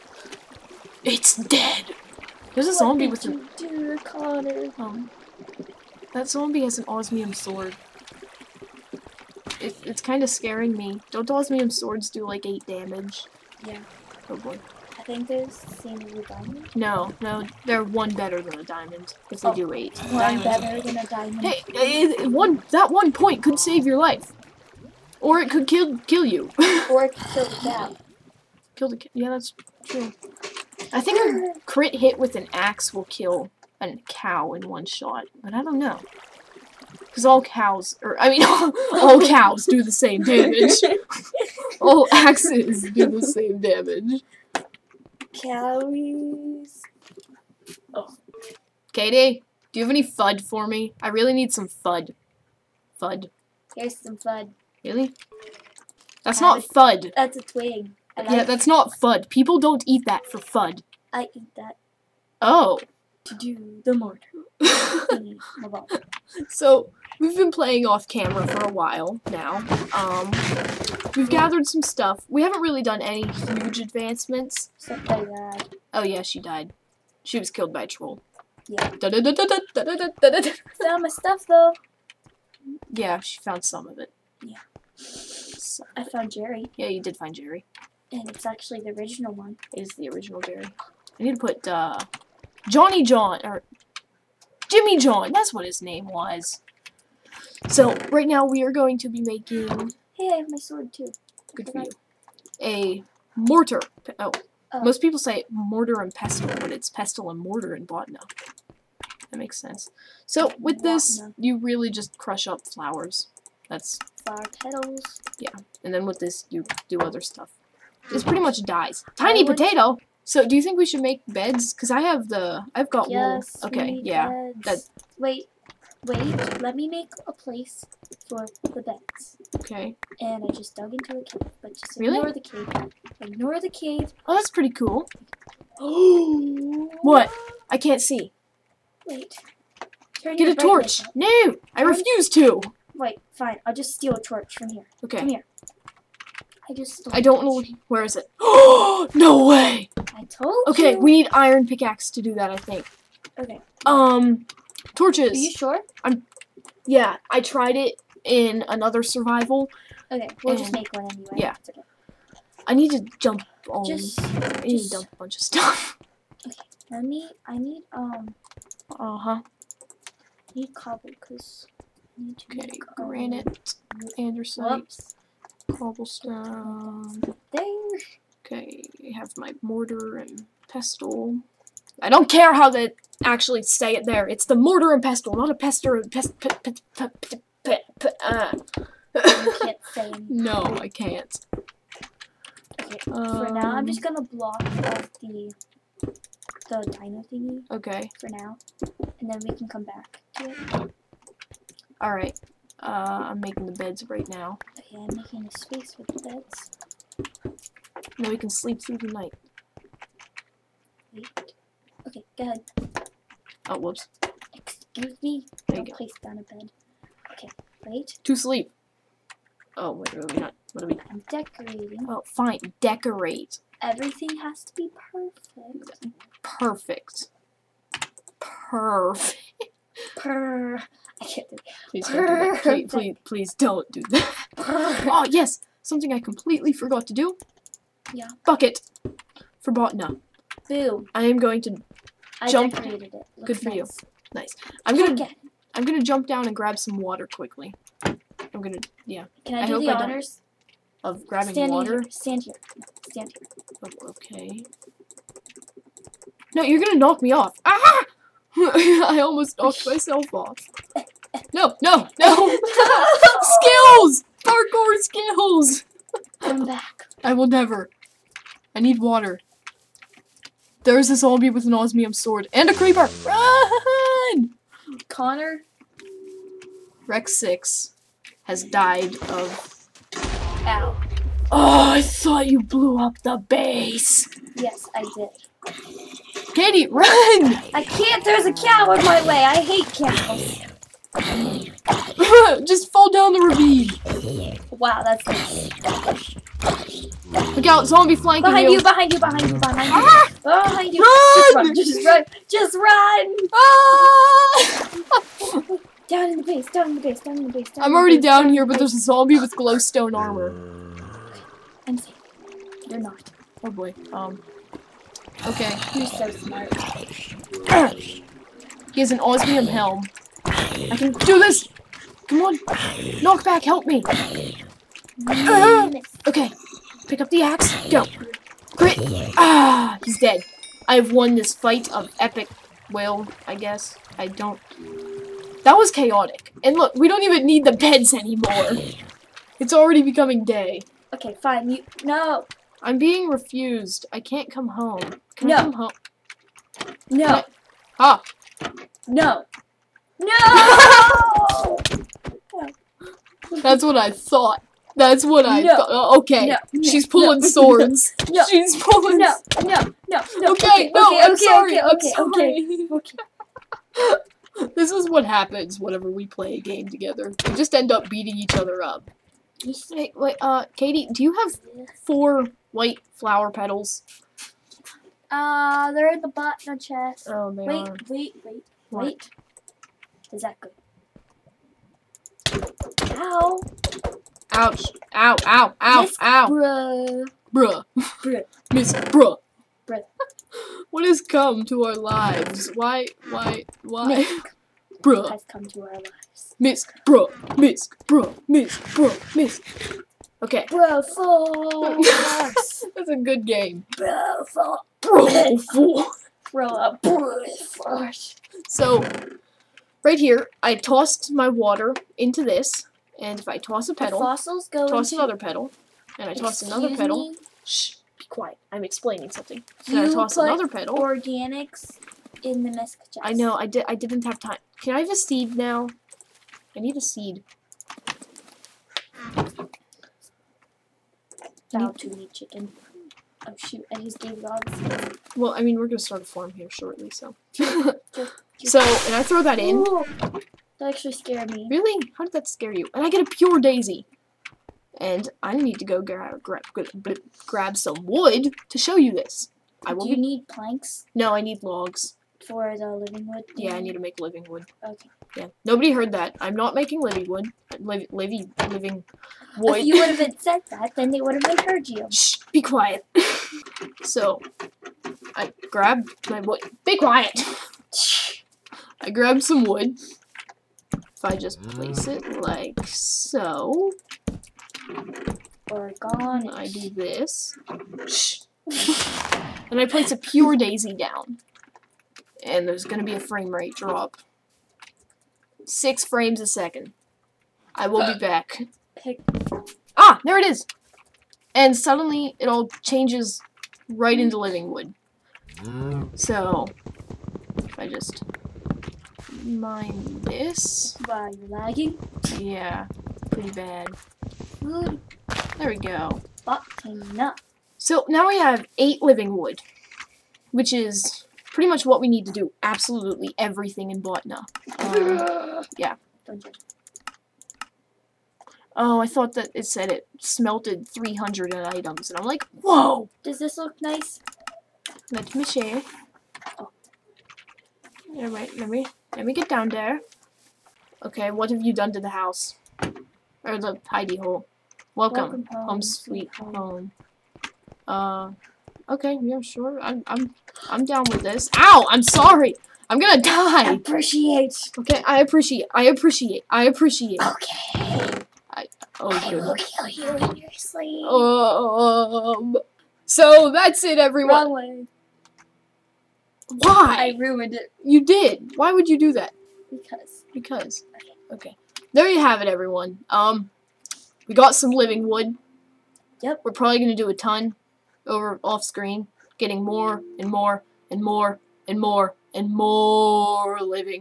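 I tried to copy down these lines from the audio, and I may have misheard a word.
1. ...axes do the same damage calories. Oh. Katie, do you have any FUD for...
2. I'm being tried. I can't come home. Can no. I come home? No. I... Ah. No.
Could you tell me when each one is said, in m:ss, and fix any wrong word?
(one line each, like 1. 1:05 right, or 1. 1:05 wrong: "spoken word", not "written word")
1. 0:42 right
2. 5:42 wrong: "refused", not "tried".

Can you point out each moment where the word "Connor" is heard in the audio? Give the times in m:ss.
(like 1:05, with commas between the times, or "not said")
0:04, 4:35.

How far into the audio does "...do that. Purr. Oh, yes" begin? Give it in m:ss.
3:53.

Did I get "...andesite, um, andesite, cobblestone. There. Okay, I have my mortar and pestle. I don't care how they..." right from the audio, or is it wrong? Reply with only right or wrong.
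wrong.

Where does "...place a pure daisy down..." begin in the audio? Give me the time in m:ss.
7:59.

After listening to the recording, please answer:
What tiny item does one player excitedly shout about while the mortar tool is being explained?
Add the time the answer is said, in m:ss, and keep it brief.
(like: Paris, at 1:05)
Tiny potato, at 1:59.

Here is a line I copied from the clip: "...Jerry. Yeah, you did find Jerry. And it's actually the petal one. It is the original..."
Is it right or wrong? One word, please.
wrong.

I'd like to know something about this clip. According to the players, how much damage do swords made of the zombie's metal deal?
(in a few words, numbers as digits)
8.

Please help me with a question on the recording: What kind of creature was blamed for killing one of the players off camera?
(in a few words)
A troll.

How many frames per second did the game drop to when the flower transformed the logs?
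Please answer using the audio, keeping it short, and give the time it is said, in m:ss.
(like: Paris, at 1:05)
6, at 8:05.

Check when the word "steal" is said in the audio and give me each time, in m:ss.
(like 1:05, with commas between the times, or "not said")
2:23.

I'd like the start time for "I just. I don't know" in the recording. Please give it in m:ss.
2:26.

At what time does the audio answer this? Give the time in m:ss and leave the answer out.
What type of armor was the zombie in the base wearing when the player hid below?
5:09.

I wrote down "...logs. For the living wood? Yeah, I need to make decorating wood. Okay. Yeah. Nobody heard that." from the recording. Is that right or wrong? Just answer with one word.
wrong.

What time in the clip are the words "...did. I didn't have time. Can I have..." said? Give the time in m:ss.
7:03.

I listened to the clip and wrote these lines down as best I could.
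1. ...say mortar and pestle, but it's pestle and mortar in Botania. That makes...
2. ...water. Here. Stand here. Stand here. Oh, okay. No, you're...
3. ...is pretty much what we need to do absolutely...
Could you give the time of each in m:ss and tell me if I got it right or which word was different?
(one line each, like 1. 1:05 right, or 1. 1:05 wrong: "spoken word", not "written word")
1. 1:45 right
2. 4:11 right
3. 8:30 right.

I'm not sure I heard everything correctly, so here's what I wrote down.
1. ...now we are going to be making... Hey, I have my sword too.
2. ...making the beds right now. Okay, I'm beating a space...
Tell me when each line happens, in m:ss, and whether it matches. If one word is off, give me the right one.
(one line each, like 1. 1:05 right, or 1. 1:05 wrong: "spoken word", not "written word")
1. 1:38 right
2. 3:23 wrong: "making", not "beating".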